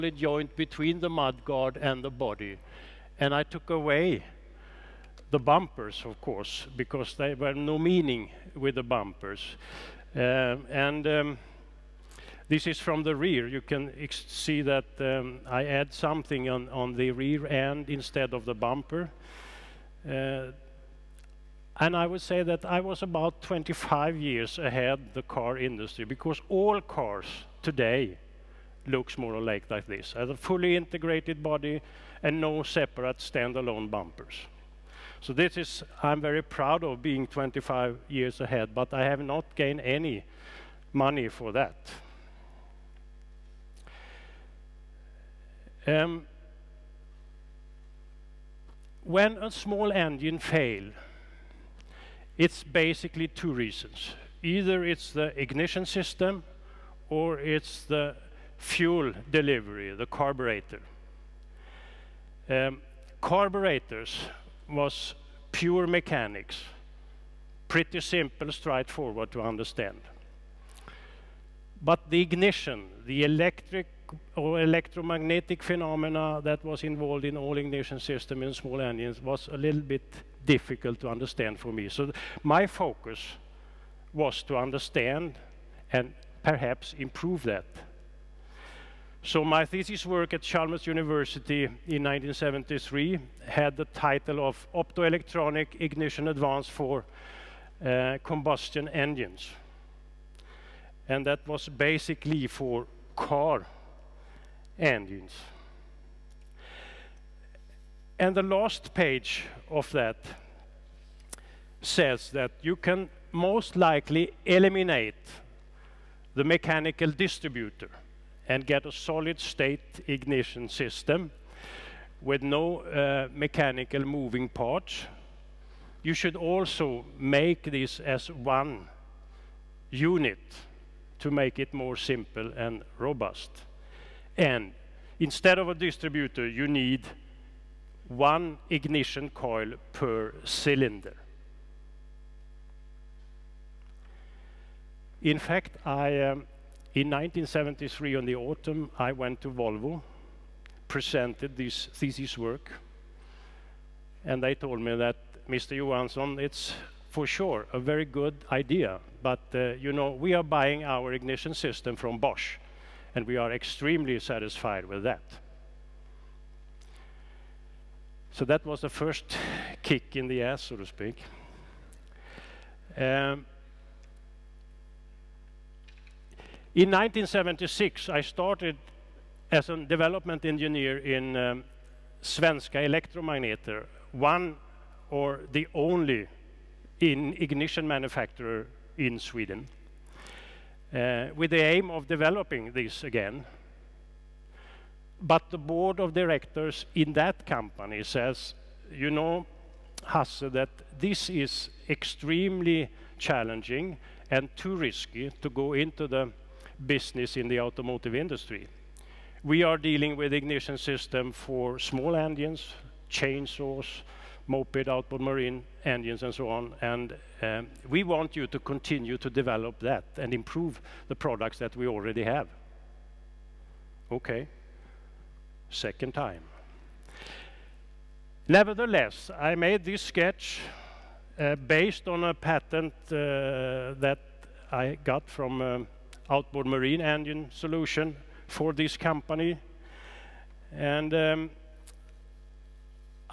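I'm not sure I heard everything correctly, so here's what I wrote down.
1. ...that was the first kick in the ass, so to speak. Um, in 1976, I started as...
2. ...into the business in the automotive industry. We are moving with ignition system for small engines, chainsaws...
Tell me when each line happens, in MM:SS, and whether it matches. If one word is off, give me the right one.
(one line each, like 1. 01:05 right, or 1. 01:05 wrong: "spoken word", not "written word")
1. 02:48 right
2. 03:25 wrong: "dealing", not "moving".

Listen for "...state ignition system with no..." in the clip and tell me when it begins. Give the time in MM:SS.
01:59.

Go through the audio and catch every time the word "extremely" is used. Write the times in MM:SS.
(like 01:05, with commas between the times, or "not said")
02:43, 03:21.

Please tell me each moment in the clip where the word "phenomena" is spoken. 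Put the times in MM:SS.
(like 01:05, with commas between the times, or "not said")
01:15.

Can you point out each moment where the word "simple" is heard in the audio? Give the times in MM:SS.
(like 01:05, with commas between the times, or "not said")
01:08, 02:11.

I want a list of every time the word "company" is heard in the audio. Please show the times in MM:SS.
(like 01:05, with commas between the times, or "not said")
03:17, 03:58.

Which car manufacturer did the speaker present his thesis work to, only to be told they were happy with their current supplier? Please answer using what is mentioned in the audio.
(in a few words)
Volvo.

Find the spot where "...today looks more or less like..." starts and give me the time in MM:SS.
00:27.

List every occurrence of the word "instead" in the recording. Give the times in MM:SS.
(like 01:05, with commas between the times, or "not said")
00:17, 02:15.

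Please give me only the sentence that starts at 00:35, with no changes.
So this is, I'm very proud of being 25 years ahead, but I have not gained any money for that.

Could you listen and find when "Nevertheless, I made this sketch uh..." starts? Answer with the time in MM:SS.
03:48.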